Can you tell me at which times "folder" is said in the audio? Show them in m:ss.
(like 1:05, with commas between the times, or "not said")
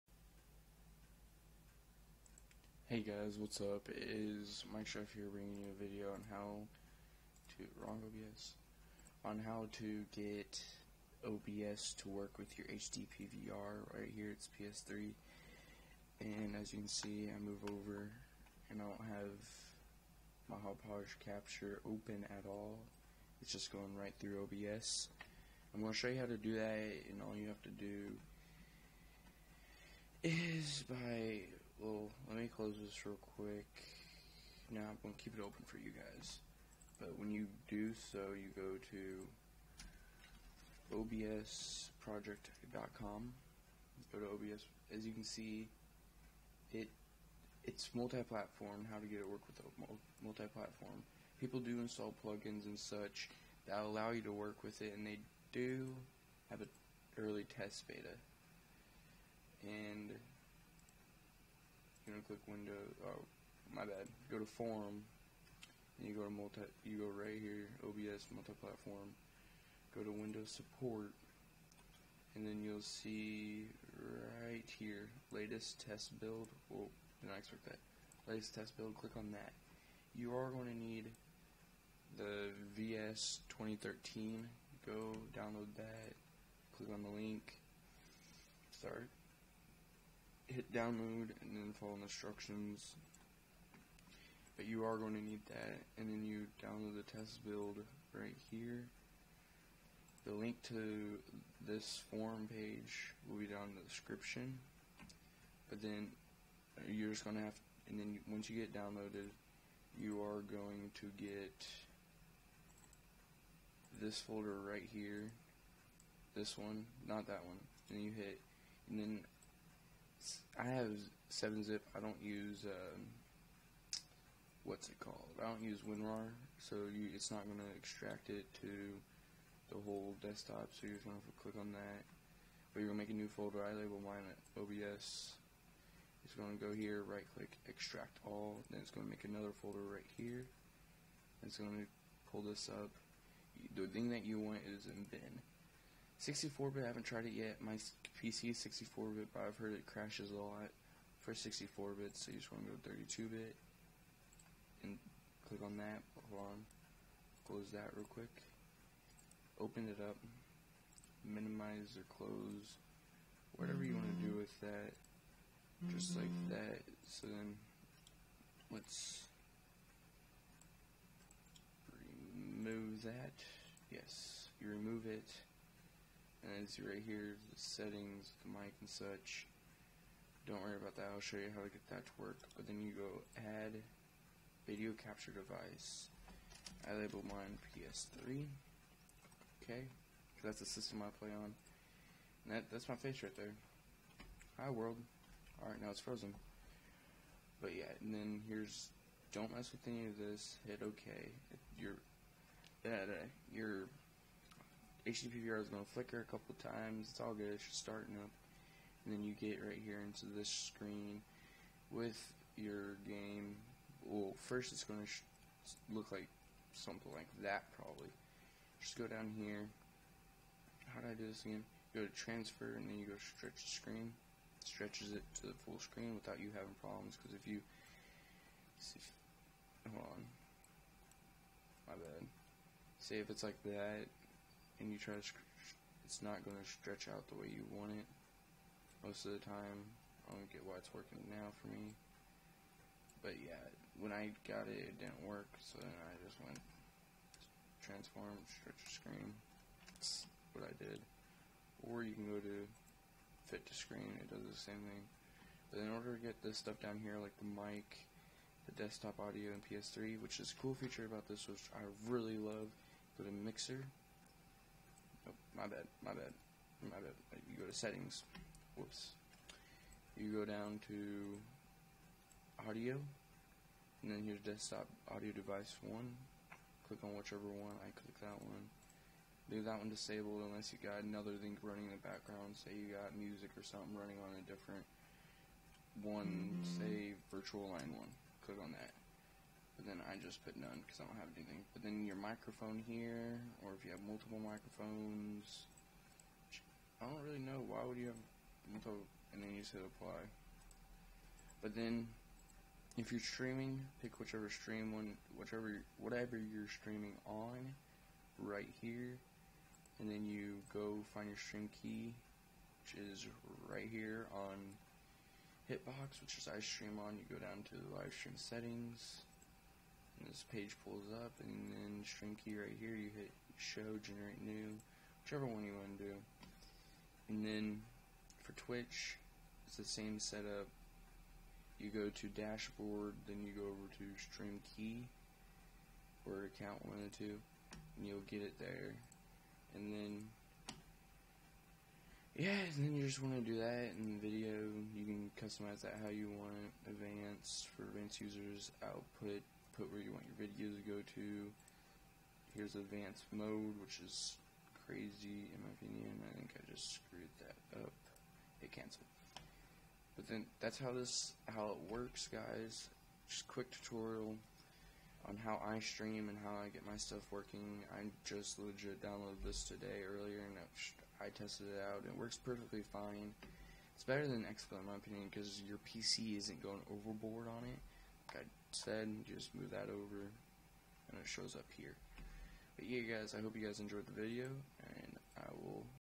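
1:54, 2:13, 2:19.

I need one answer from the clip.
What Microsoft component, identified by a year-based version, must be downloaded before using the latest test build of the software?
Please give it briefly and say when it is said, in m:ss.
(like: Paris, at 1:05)
VS 2013, at 1:22.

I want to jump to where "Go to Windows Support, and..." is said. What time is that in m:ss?
1:09.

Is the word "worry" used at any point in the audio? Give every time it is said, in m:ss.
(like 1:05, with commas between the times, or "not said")
3:00.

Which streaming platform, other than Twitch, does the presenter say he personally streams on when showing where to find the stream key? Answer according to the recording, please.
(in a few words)
Hitbox.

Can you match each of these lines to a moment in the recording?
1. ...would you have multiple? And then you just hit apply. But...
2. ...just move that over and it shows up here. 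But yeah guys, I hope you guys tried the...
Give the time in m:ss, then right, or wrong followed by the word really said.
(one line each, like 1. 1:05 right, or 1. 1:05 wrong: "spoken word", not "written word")
1. 4:57 right
2. 6:19 wrong: "enjoyed", not "tried".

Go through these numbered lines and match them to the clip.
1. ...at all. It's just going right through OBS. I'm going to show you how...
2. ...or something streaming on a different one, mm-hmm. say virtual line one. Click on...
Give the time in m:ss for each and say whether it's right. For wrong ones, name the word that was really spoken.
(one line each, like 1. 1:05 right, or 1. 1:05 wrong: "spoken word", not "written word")
1. 0:22 right
2. 4:43 wrong: "running", not "streaming".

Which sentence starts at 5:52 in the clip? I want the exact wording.
Here's advanced mode, which is crazy in my opinion.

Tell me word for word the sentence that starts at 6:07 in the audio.
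I just legit downloaded this today earlier and I tested it out.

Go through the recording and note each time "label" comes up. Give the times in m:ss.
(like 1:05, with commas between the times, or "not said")
2:13, 3:06.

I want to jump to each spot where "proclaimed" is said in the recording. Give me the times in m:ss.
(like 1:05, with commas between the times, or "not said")
not said.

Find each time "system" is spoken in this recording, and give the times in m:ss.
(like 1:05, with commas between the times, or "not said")
3:10.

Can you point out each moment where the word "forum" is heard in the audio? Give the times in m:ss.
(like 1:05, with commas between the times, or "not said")
1:04, 1:42.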